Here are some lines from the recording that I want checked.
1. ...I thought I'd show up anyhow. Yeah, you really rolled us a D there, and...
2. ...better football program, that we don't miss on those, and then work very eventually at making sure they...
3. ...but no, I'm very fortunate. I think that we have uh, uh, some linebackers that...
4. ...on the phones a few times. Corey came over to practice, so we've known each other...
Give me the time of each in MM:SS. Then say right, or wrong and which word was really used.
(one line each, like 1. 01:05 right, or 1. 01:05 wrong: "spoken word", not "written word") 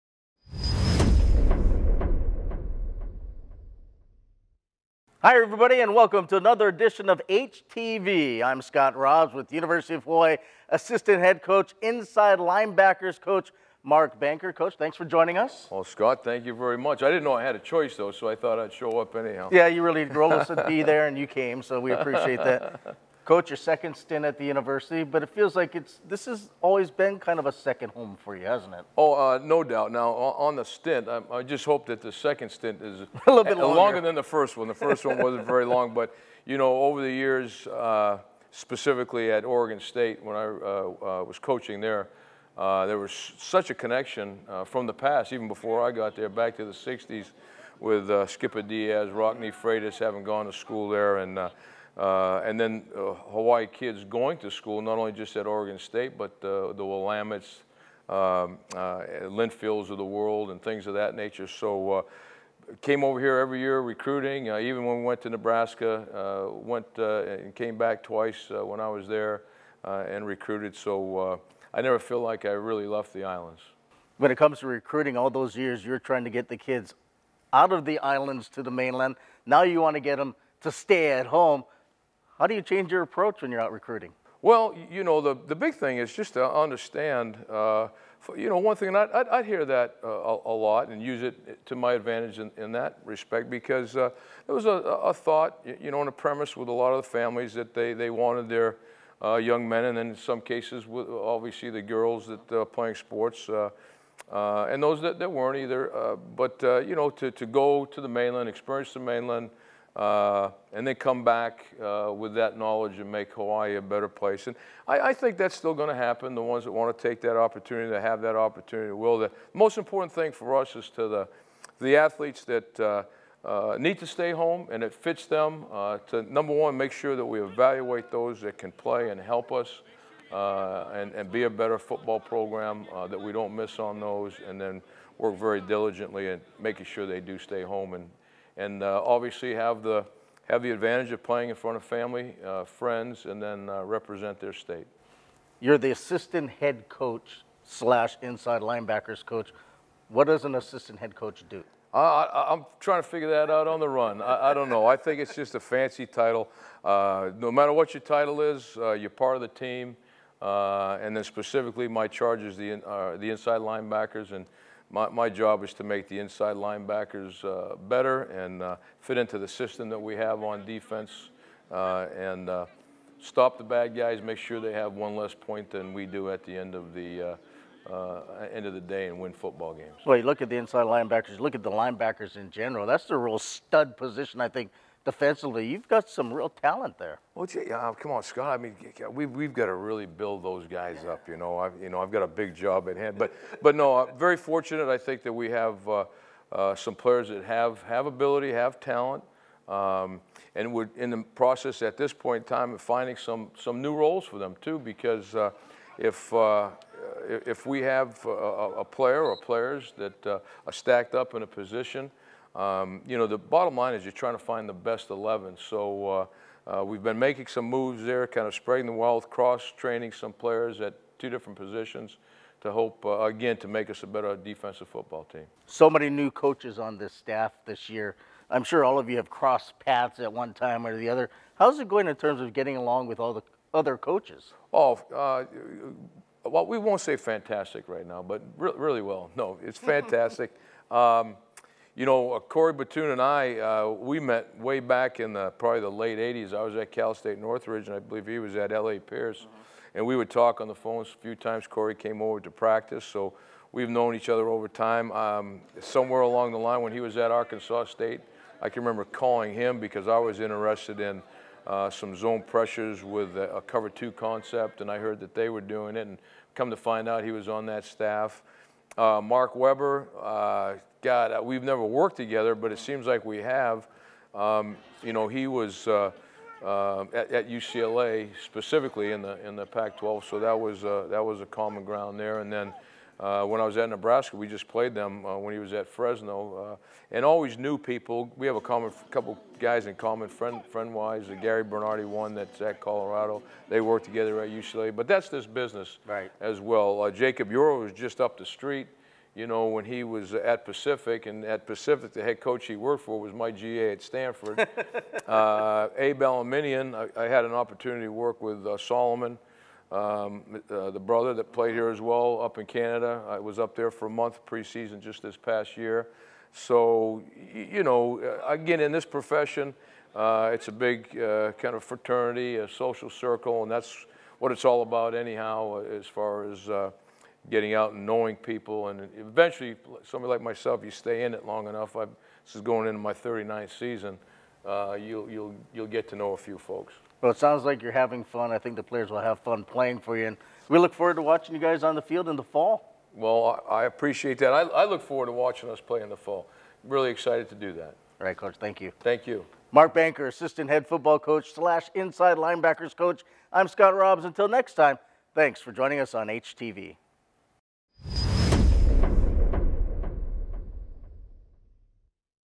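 1. 00:18 right
2. 02:11 wrong: "diligently", not "eventually"
3. 03:13 wrong: "players", not "linebackers"
4. 04:10 right.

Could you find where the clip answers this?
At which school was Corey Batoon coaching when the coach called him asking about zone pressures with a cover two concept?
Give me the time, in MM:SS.
04:17.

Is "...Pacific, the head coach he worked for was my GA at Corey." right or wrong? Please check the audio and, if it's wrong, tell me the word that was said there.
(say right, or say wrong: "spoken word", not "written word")
wrong: "Stanford", not "Corey".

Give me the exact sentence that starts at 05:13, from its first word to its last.
I was up there for a month preseason just this past year.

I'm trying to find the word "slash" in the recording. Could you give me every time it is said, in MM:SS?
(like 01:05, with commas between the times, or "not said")
02:27, 05:51.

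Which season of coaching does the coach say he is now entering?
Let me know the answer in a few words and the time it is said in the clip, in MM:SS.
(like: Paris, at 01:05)
39th, at 05:33.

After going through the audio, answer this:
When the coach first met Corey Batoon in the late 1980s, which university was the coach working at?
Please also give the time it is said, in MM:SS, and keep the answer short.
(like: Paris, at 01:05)
Cal State Northridge, at 04:06.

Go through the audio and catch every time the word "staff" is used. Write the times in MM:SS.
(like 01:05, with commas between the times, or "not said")
03:47, 04:27.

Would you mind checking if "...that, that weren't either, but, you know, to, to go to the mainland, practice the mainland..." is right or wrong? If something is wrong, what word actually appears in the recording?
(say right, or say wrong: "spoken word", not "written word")
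wrong: "experience", not "practice".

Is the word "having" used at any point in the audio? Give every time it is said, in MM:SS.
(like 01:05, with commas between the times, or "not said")
00:49, 05:37.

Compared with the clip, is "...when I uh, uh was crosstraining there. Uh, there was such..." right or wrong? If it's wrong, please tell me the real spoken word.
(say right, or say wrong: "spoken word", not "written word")
wrong: "coaching", not "crosstraining".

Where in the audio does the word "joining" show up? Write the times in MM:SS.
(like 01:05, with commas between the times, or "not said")
00:15, 05:55.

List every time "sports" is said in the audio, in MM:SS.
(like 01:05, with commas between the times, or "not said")
01:42.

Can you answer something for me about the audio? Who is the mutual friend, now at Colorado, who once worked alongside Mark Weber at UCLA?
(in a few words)
Gary Bernardi.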